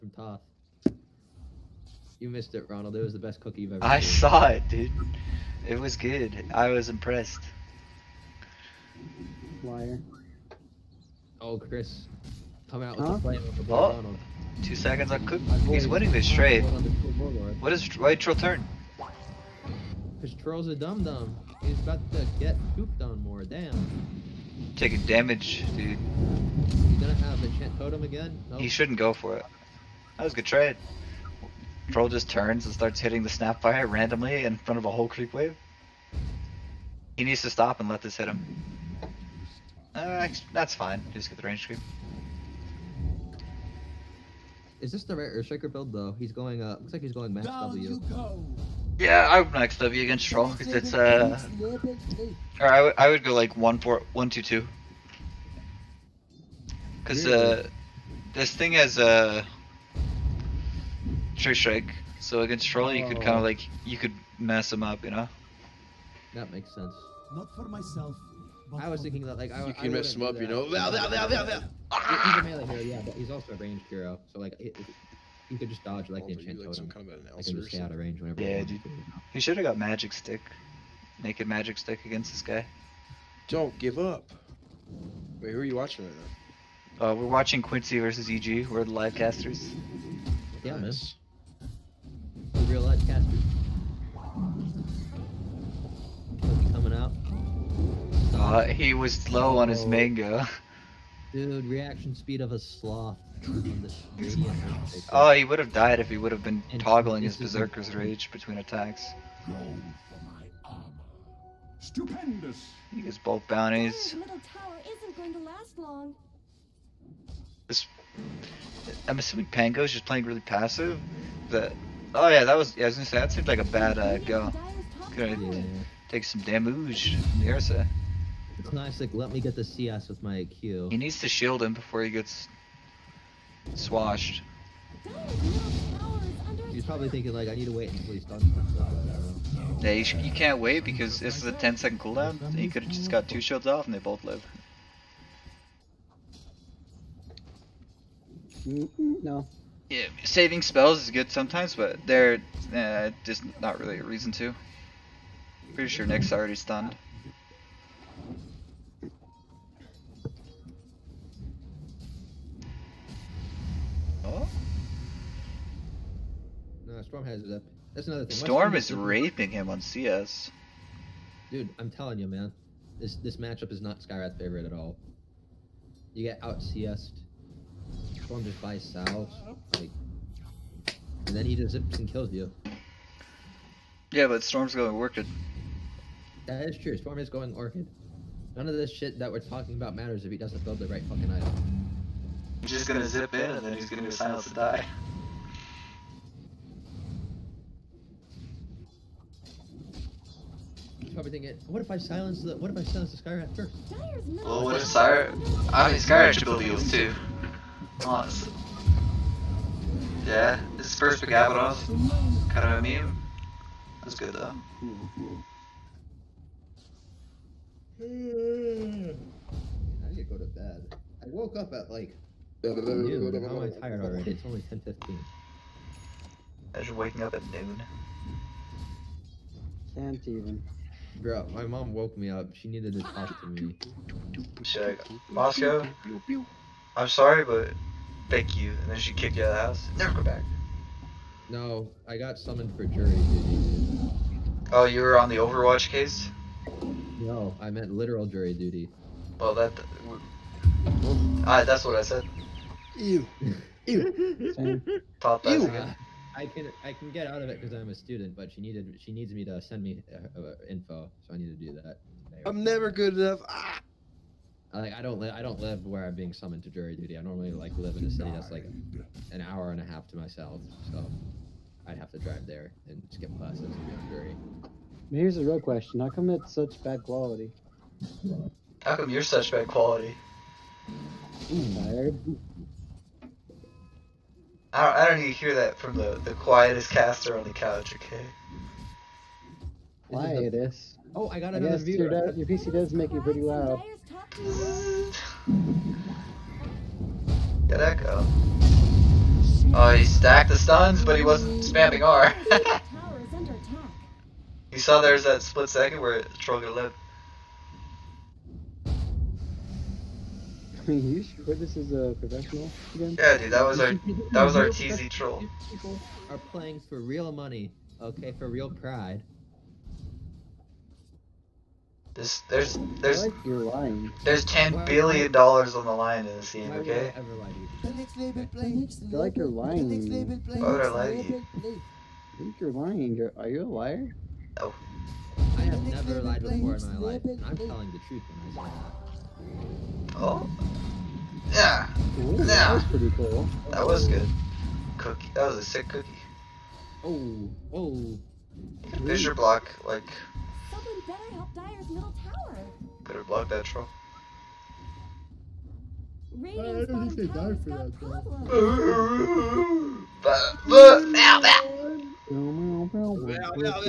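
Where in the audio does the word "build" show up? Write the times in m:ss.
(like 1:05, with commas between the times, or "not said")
0:45, 3:10, 3:26.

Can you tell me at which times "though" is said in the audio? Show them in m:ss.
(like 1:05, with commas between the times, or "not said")
0:45, 3:34.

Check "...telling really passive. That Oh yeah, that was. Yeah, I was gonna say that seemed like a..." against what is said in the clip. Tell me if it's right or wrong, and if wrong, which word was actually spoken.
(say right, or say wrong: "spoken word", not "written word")
wrong: "playing", not "telling".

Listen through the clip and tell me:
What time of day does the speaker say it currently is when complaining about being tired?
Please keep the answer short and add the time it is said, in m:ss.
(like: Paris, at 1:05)
10:15, at 3:44.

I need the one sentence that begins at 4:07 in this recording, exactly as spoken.
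No, I meant literal jury duty.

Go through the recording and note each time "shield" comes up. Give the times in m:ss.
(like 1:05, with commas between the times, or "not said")
2:11, 2:23.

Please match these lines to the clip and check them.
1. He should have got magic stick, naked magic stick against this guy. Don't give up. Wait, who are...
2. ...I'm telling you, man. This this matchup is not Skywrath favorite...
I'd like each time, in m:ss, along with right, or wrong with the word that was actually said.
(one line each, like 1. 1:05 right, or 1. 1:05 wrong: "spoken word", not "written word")
1. 1:19 right
2. 2:51 right.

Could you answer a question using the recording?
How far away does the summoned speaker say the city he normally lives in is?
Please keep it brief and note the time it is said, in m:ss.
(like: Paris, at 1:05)
An hour and a half, at 4:29.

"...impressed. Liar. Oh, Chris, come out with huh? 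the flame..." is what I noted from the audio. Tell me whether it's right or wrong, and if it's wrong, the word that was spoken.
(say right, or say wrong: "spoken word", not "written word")
right.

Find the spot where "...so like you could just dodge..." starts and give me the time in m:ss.
1:14.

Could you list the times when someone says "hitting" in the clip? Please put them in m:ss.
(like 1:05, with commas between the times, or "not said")
0:32.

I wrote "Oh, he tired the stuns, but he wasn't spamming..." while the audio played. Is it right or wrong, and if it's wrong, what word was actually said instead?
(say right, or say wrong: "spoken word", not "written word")
wrong: "stacked", not "tired".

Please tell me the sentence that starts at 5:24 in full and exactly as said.
There's ten why, billion dollars on the line in this game, okay?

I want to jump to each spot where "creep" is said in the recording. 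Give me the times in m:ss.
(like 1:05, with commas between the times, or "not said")
0:35, 0:41.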